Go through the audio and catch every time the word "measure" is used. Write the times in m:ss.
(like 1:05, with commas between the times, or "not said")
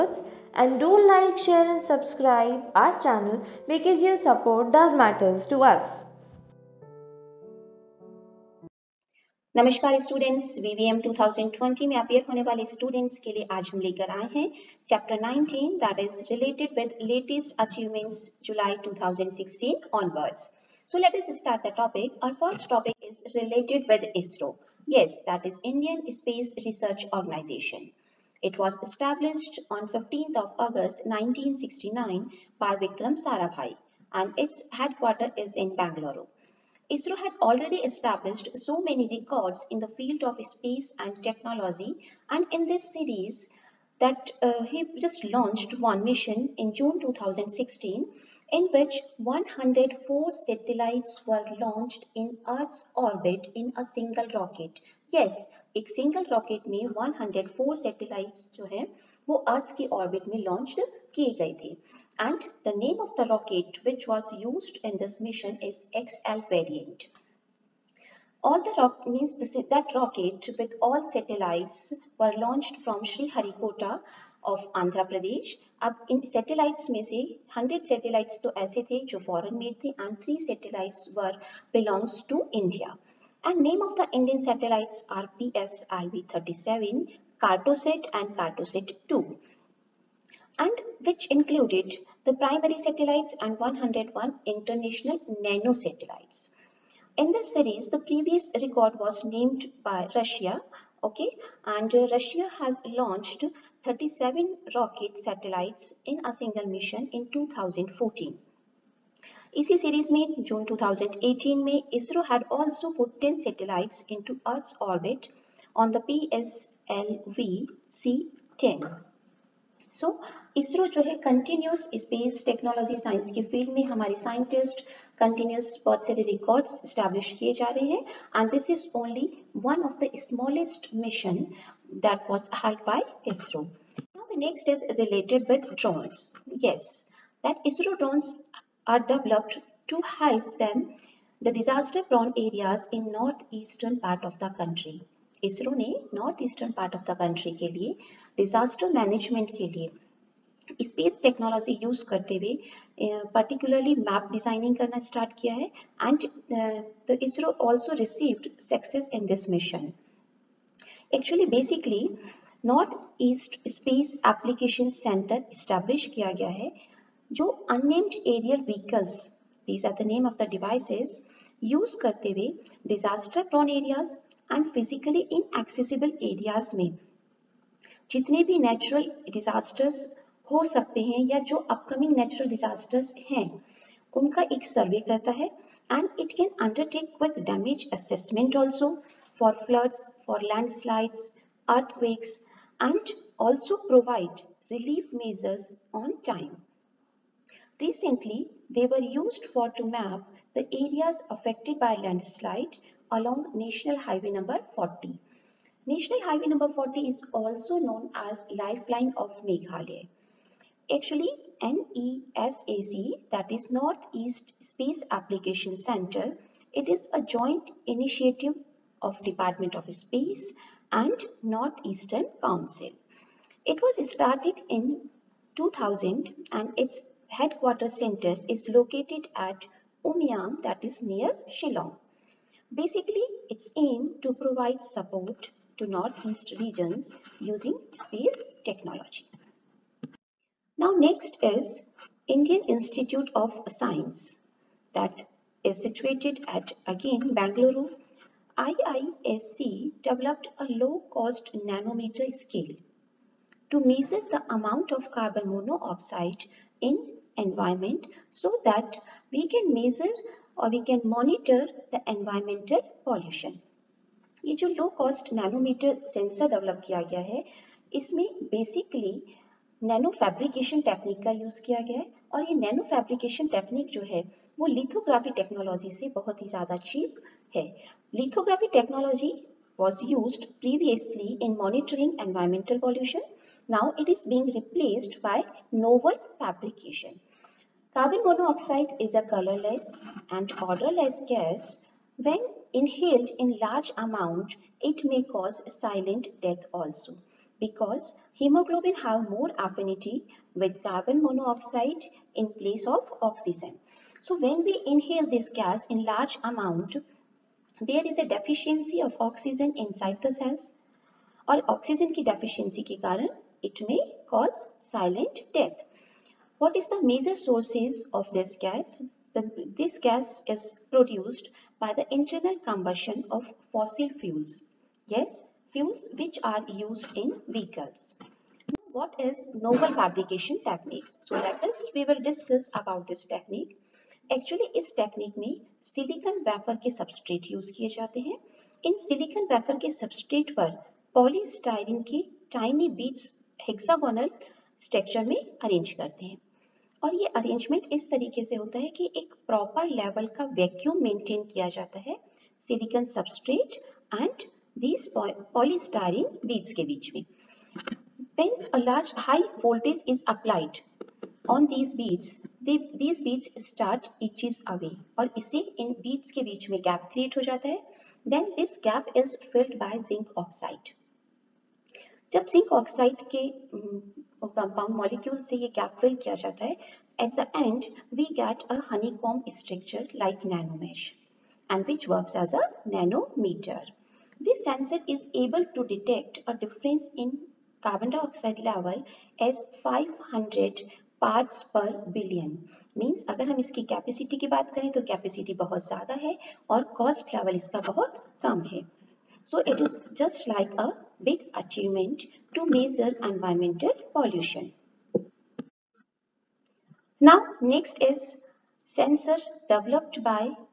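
4:13, 4:19.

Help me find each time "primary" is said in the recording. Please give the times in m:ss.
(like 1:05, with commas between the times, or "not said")
1:32.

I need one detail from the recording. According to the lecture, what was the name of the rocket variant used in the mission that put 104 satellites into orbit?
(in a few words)
XL variant.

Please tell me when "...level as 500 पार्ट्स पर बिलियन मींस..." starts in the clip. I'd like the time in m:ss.
6:28.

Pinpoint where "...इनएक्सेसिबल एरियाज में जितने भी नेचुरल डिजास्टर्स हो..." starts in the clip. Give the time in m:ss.
2:55.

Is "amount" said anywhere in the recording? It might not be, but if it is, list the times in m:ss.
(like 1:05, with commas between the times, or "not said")
4:14, 5:06.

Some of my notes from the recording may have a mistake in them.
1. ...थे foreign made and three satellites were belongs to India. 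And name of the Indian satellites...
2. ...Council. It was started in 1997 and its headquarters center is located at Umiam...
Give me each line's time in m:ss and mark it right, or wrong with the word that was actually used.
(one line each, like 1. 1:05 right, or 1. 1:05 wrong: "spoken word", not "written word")
1. 1:18 right
2. 3:42 wrong: "2000", not "1997".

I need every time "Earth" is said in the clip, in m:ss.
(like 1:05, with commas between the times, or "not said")
0:52, 0:59, 1:54.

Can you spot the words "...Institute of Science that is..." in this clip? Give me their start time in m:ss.
4:02.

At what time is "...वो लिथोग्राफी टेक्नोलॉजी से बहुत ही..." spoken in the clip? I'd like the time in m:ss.
4:34.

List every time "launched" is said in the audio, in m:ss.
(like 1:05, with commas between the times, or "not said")
0:45, 0:51, 1:12, 1:42.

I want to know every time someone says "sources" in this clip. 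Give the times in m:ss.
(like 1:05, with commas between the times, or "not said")
5:17.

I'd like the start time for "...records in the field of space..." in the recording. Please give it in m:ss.
0:39.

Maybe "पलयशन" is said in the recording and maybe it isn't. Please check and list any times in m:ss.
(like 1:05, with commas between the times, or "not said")
4:42, 6:44.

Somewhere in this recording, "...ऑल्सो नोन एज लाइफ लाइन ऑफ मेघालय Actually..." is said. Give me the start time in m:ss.
3:27.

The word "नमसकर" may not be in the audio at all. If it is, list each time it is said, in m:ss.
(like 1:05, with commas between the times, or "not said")
0:09.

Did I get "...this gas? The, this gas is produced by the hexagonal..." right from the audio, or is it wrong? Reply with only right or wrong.
wrong.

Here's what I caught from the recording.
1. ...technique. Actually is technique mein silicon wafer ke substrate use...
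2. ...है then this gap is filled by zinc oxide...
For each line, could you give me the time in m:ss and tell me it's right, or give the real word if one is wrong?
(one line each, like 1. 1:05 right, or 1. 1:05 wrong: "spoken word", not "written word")
1. 5:33 right
2. 6:07 right.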